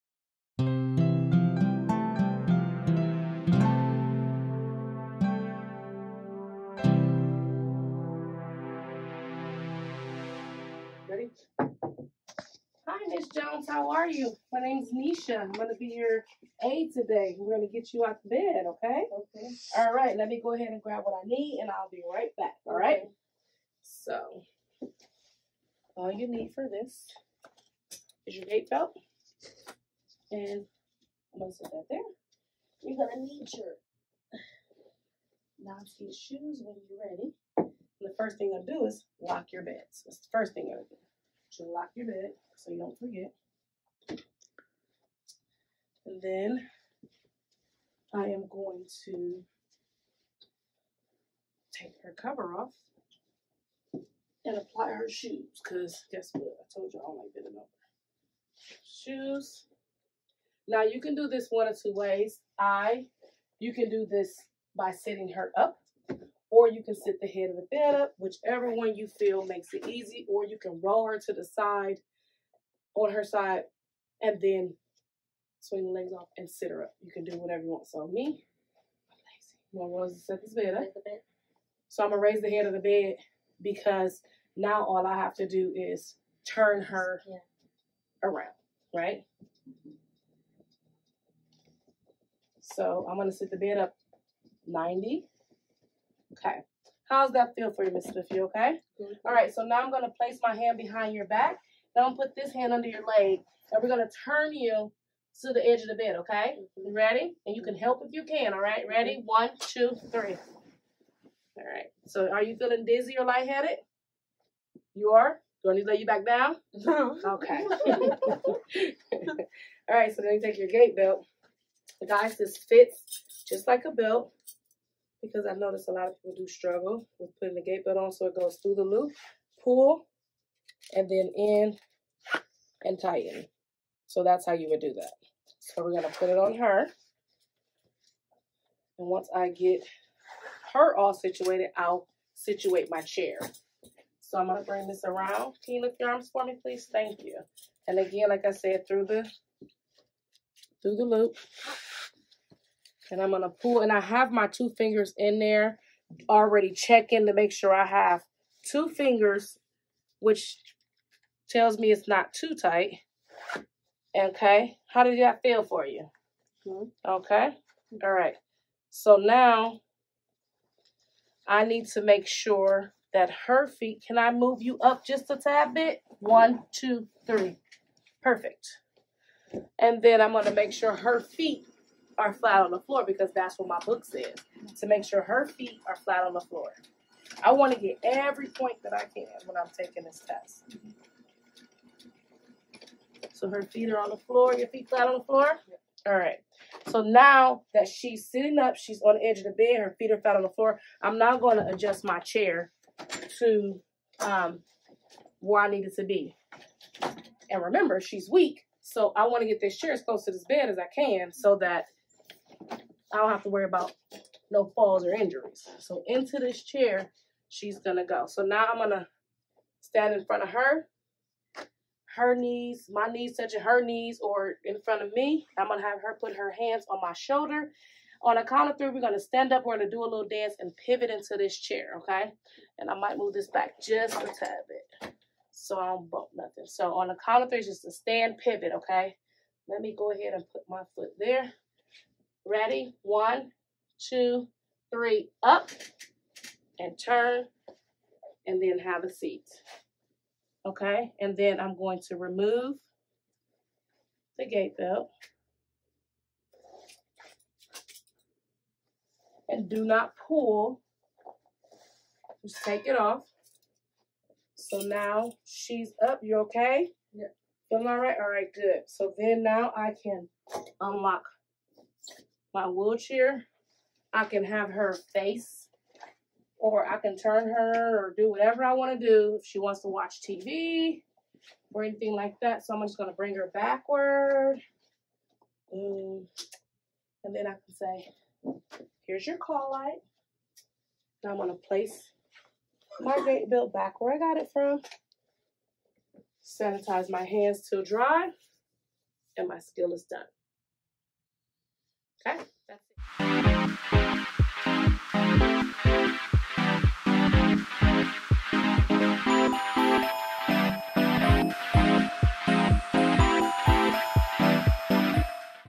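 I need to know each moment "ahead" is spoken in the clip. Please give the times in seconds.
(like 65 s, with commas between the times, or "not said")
20 s, 240 s.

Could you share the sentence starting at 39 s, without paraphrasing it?
So that's the first thing i will going to do lock your bed so you don't forget.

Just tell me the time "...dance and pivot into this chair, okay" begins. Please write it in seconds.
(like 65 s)
230 s.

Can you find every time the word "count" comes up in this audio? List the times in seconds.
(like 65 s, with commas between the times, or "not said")
228 s, 237 s.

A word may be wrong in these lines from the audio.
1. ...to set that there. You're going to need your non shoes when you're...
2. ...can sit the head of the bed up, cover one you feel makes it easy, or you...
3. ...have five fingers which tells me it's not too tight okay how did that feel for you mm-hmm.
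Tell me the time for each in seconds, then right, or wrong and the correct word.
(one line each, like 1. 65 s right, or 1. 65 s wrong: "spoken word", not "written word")
1. 31 s right
2. 66 s wrong: "whichever", not "cover"
3. 157 s wrong: "two", not "five".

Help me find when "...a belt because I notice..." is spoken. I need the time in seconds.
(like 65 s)
123 s.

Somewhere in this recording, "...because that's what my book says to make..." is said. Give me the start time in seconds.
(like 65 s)
183 s.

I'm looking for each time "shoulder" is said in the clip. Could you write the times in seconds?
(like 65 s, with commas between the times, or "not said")
227 s.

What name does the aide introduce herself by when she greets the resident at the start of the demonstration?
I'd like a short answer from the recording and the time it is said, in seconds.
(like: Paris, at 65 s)
Nisha, at 14 s.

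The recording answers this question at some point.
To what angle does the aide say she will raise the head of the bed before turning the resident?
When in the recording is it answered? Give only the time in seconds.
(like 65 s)
94 s.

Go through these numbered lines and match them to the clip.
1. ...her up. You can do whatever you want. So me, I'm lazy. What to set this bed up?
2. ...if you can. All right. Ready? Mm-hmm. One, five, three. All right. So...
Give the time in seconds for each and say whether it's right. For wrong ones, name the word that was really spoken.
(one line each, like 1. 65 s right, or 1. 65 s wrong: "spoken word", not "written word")
1. 76 s right
2. 108 s wrong: "two", not "five".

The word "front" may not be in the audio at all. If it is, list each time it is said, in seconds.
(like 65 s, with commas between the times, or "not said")
220 s, 224 s.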